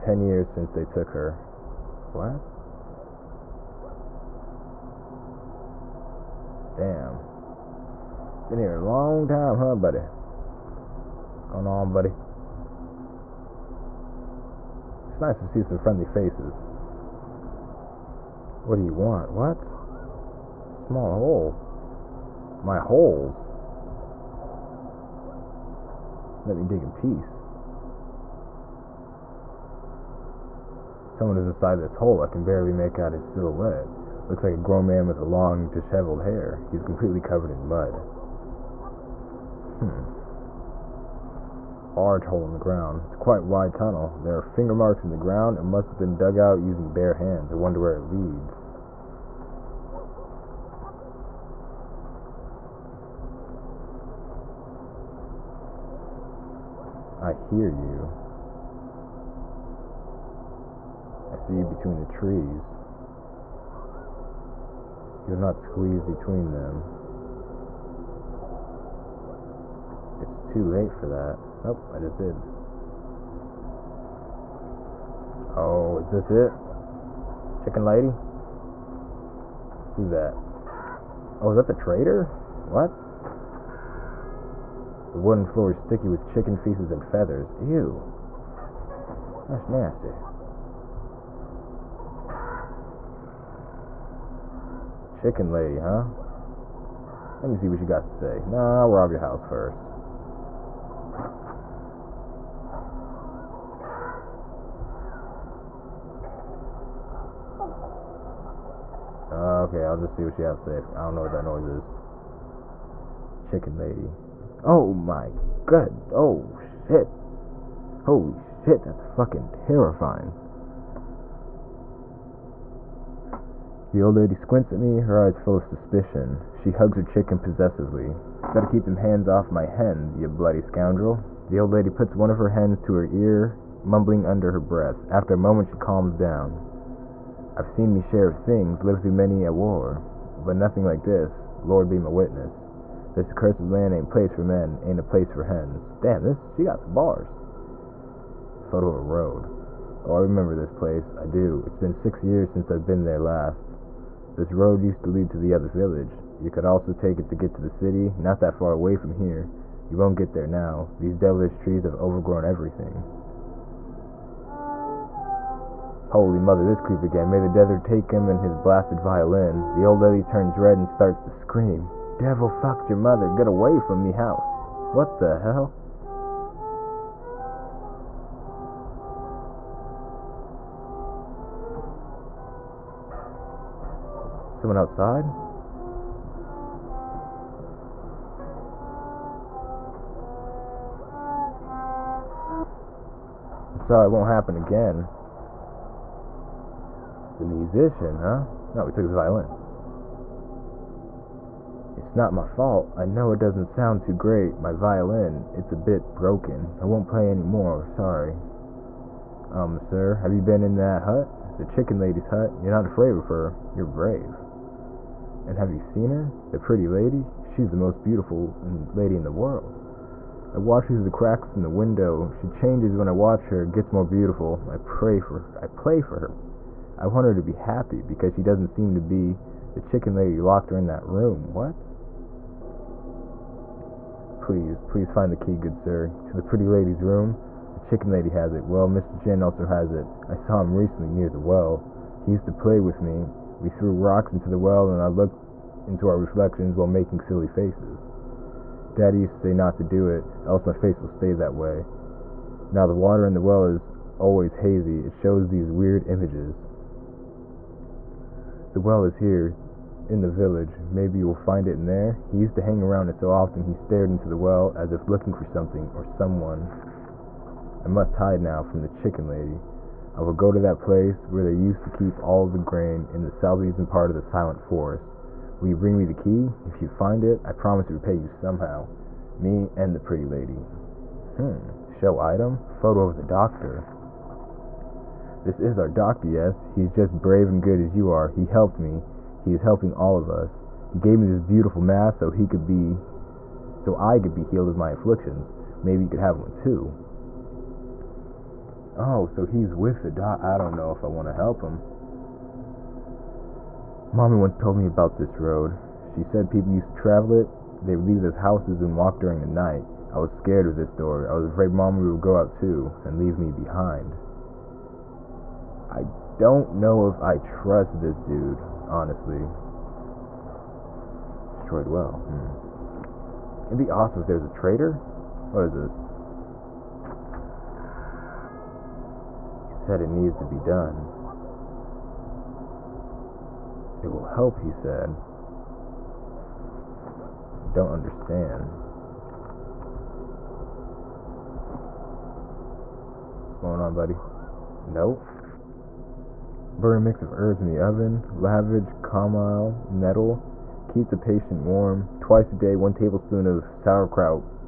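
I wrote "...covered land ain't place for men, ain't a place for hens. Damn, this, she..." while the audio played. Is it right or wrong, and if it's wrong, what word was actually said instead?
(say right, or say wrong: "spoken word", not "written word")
wrong: "accursed", not "covered".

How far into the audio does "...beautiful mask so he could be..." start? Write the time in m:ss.
4:51.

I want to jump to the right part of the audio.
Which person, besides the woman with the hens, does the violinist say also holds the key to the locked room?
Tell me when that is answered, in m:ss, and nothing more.
3:58.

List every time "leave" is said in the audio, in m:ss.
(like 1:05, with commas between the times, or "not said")
5:08, 5:13.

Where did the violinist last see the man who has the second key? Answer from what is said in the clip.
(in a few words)
near the well.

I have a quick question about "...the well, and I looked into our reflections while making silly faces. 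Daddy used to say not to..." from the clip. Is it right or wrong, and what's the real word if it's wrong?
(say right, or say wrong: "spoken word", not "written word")
right.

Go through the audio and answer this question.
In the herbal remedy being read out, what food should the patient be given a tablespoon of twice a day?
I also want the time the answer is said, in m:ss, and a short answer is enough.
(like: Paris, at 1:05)
sauerkraut, at 5:53.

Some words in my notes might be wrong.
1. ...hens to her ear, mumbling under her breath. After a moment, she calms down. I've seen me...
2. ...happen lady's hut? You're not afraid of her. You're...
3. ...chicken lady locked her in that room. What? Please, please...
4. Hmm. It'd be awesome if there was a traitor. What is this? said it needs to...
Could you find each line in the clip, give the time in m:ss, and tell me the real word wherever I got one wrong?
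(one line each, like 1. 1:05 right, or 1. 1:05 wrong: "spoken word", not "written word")
1. 2:12 right
2. 3:31 wrong: "chicken", not "happen"
3. 3:49 right
4. 5:22 right.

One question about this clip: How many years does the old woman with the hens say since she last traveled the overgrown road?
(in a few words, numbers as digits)
6.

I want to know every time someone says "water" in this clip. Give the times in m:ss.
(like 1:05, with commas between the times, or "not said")
4:12.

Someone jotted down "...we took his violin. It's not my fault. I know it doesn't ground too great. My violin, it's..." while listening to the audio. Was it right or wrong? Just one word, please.
wrong.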